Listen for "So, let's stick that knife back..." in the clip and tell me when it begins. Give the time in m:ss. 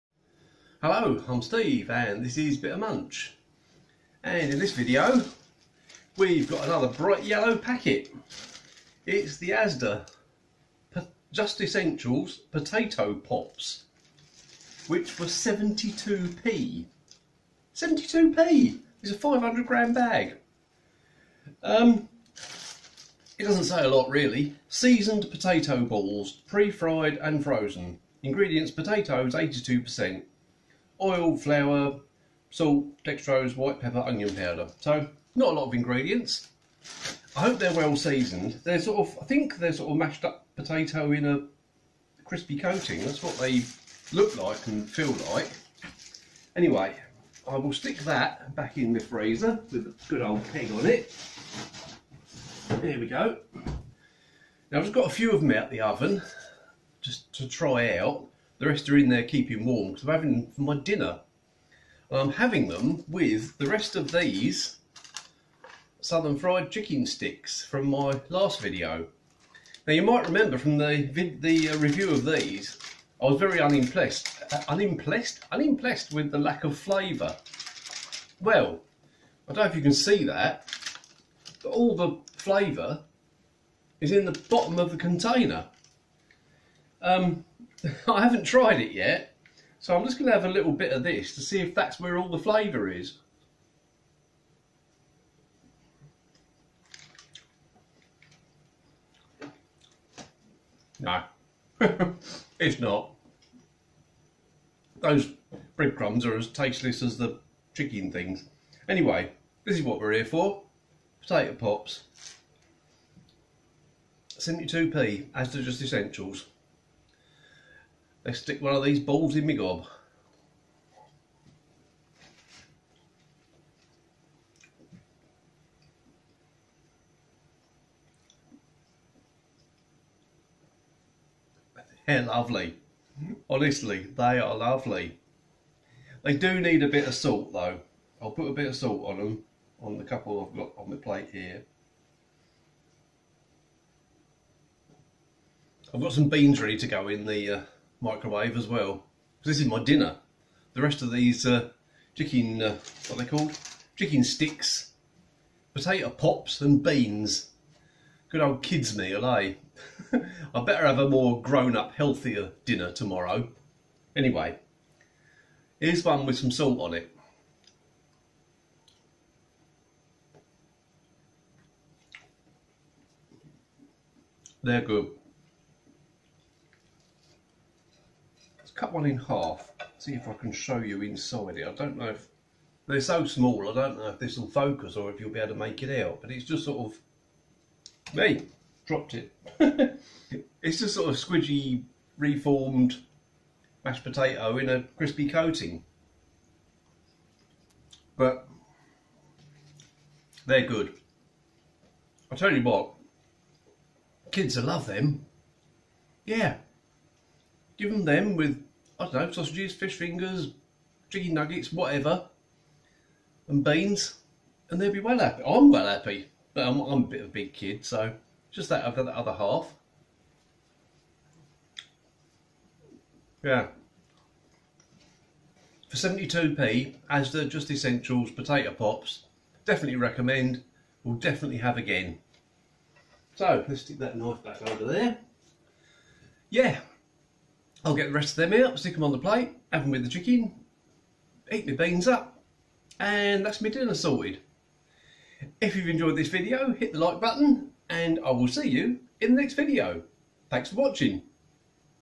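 3:53.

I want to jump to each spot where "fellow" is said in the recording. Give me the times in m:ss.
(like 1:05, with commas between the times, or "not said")
not said.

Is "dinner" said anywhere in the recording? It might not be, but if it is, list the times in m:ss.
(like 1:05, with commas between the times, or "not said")
1:00, 2:29, 2:42, 4:03.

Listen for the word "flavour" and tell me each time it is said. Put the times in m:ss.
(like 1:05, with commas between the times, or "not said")
1:16, 1:22, 1:32.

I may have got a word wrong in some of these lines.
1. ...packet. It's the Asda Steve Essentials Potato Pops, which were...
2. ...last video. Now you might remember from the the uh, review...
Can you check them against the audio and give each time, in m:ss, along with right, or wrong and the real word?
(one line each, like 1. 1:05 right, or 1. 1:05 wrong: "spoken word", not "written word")
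1. 0:07 wrong: "Just", not "Steve"
2. 1:08 right.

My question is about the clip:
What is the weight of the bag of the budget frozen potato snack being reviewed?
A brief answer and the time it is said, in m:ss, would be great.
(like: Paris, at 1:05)
500 grams, at 0:19.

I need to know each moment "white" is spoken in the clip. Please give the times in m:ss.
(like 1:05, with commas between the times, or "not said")
0:33.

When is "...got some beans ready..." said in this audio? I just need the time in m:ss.
2:26.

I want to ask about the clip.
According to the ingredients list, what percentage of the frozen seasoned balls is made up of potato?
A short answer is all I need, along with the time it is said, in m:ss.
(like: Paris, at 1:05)
82%, at 0:29.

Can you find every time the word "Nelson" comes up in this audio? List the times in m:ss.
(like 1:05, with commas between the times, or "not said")
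not said.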